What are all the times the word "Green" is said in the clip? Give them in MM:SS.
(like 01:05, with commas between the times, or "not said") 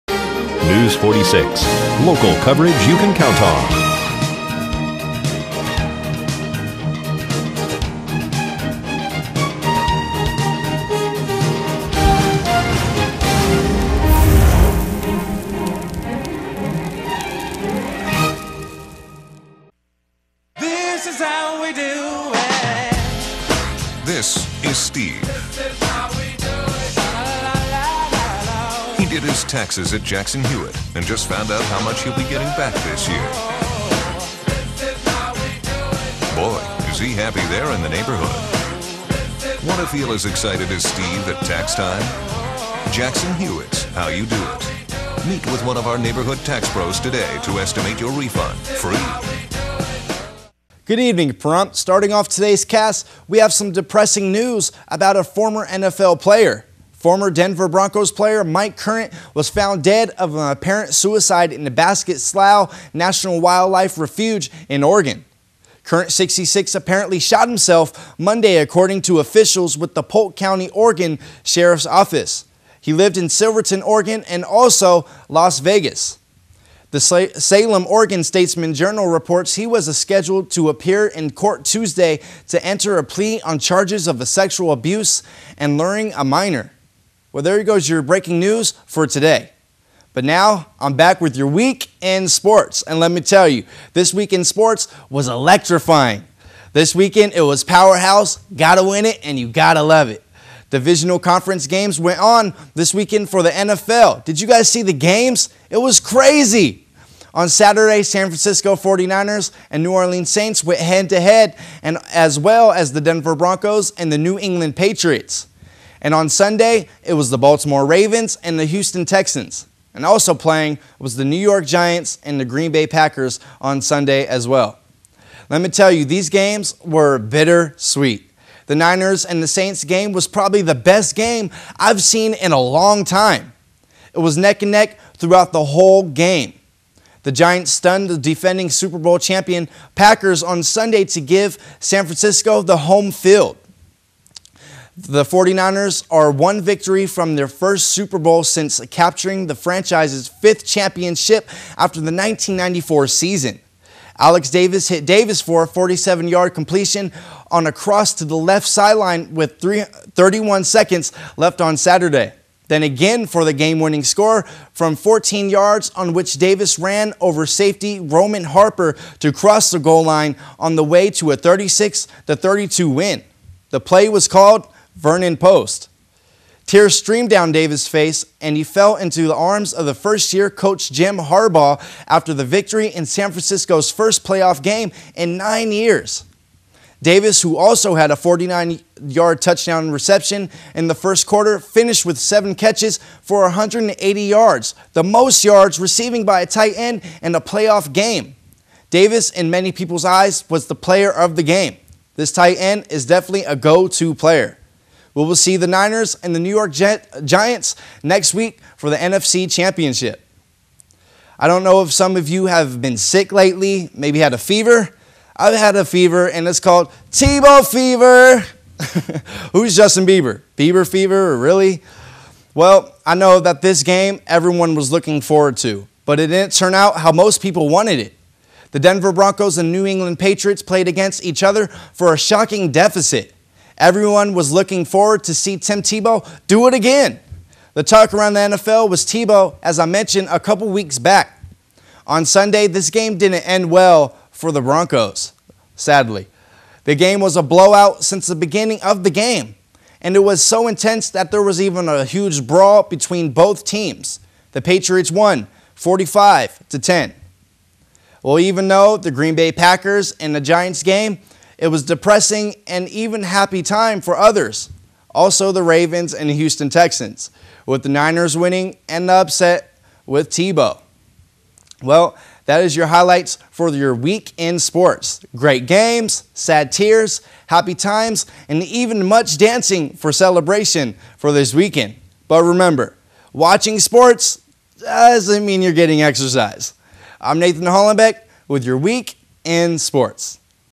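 02:02, 04:19.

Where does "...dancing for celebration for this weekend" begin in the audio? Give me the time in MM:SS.
04:39.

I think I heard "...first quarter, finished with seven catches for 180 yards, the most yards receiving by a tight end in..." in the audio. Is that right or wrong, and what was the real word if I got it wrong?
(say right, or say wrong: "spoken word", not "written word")
right.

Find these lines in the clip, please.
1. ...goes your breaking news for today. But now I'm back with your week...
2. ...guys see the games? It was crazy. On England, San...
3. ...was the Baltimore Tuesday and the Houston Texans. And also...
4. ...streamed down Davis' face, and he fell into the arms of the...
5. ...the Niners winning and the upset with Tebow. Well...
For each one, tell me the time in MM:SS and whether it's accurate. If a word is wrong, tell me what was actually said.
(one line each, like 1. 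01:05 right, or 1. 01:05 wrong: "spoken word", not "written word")
1. 01:27 right
2. 01:44 wrong: "Saturday", not "England"
3. 01:57 wrong: "Ravens", not "Tuesday"
4. 02:56 right
5. 04:27 right.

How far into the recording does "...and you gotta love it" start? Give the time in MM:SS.
01:39.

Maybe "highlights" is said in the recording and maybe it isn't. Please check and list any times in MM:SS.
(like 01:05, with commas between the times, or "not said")
04:32.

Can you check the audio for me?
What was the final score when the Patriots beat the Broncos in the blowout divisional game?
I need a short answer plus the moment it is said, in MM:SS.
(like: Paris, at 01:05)
45 to 10, at 04:15.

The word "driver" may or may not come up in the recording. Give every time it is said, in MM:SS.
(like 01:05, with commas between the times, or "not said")
not said.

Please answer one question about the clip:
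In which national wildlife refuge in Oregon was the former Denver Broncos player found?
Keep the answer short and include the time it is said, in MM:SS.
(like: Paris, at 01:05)
Basket Slough National Wildlife Refuge, at 01:01.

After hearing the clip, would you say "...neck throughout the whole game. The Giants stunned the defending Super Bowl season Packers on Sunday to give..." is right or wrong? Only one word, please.
wrong.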